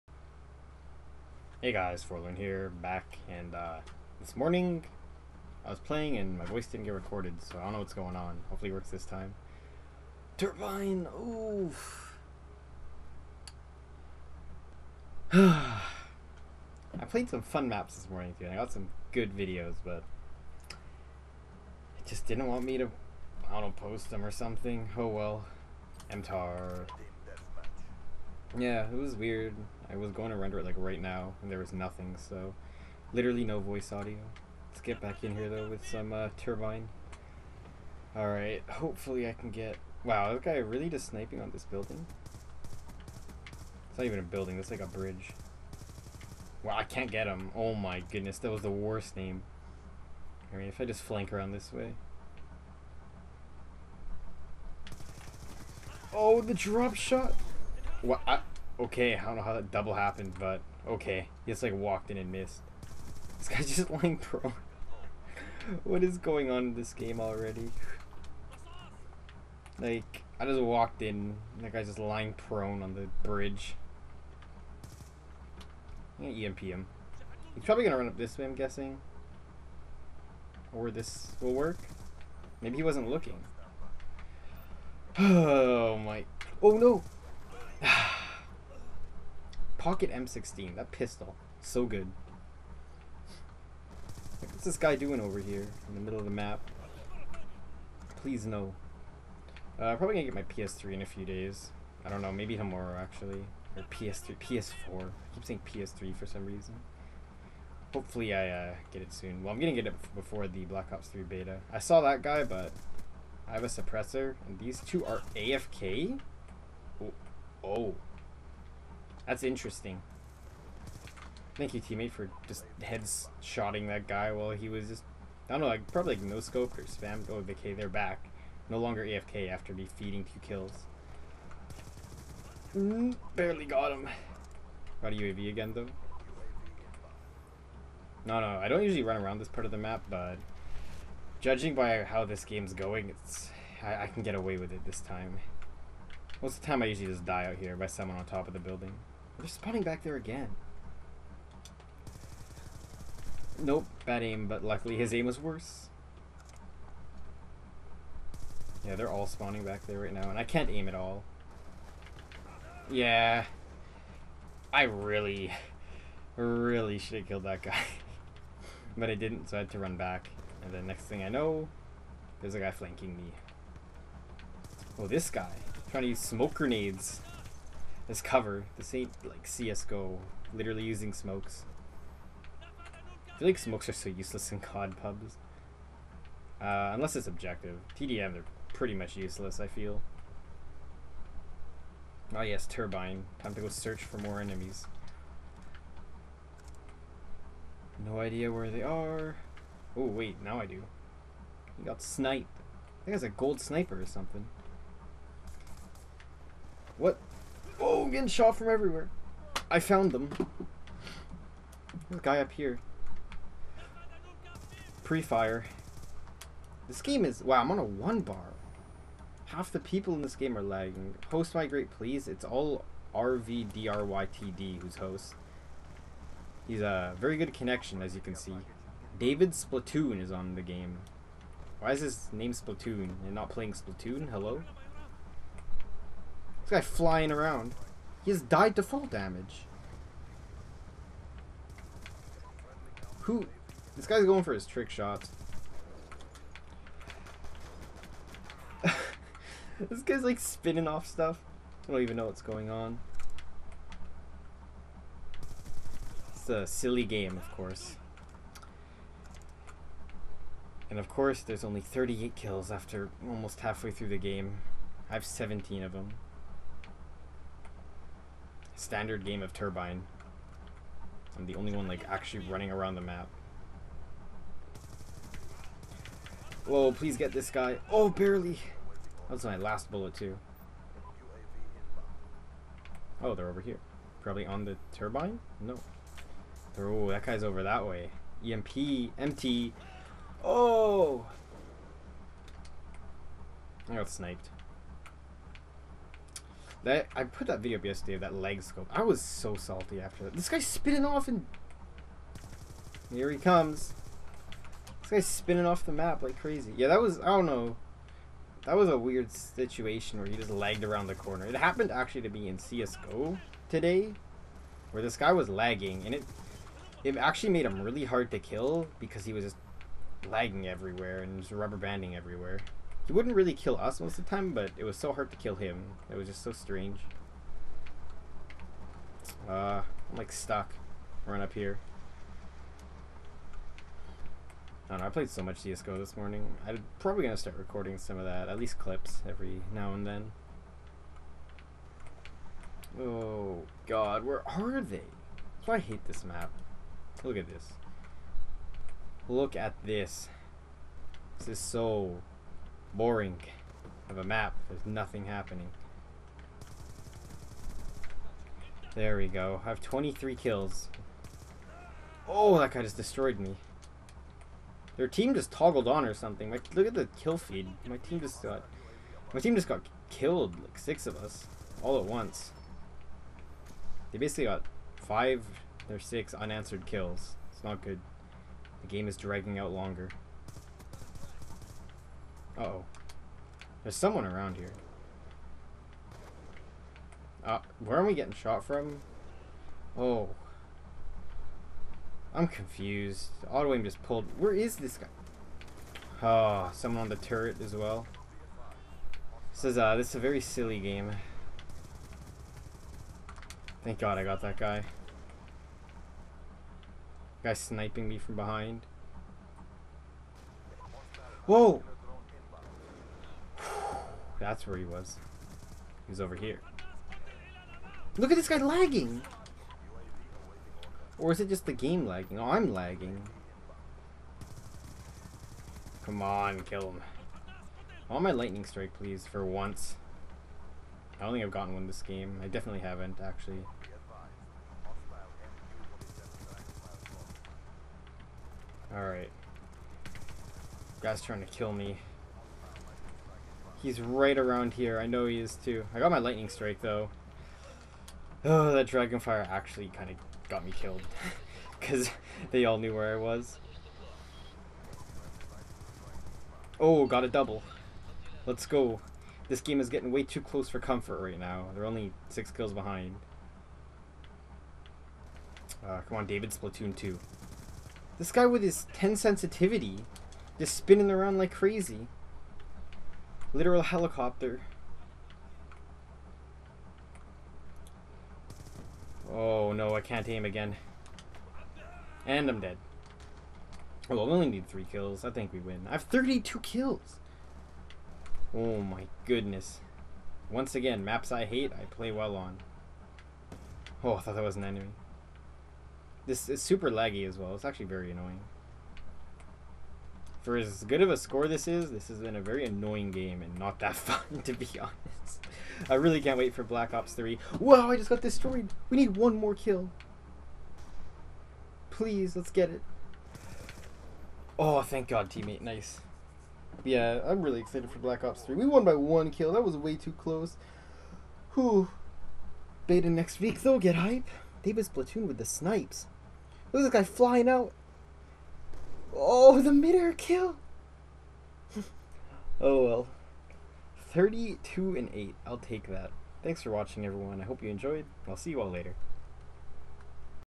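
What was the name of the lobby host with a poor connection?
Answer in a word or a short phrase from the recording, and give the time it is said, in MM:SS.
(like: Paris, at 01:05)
RVDRYTD, at 03:43.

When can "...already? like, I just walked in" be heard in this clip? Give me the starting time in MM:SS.
01:07.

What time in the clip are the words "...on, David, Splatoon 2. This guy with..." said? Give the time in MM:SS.
07:46.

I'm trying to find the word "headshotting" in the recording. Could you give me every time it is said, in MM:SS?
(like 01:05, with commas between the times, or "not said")
02:02.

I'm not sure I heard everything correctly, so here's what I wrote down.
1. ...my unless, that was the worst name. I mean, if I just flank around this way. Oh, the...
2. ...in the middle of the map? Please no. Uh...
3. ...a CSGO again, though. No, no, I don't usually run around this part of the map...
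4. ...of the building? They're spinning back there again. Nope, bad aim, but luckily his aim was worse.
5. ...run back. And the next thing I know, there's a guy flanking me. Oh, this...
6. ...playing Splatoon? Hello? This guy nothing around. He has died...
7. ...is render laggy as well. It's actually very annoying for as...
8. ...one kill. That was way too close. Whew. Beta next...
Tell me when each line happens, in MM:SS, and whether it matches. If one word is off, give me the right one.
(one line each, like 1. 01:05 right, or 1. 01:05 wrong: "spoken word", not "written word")
1. 00:47 wrong: "goodness", not "unless"
2. 01:35 right
3. 02:15 wrong: "UAV", not "CSGO"
4. 02:28 wrong: "spawning", not "spinning"
5. 02:49 right
6. 03:53 wrong: "flying", not "nothing"
7. 08:16 wrong: "super", not "render"
8. 08:38 right.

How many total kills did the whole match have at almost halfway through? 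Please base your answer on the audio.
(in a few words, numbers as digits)
38.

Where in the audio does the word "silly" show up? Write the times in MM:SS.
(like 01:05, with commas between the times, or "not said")
04:16, 06:40.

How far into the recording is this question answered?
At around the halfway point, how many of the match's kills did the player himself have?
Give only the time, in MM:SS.
04:25.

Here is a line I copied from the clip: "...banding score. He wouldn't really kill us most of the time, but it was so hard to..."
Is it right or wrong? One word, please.
wrong.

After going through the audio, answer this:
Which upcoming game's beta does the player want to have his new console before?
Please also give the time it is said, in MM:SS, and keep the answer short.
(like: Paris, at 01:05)
Black Ops 3, at 01:50.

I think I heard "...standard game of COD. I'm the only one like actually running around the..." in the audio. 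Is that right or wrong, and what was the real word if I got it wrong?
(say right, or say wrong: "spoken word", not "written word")
wrong: "Turbine", not "COD".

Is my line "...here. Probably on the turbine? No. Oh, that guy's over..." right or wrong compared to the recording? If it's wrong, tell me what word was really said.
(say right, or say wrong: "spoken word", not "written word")
right.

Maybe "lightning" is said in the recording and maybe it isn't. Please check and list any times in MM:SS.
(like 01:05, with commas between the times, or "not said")
07:08, 07:26.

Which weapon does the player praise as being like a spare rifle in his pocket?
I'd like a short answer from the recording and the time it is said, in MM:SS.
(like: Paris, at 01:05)
M16, at 01:30.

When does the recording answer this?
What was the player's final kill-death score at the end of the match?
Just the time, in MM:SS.
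08:54.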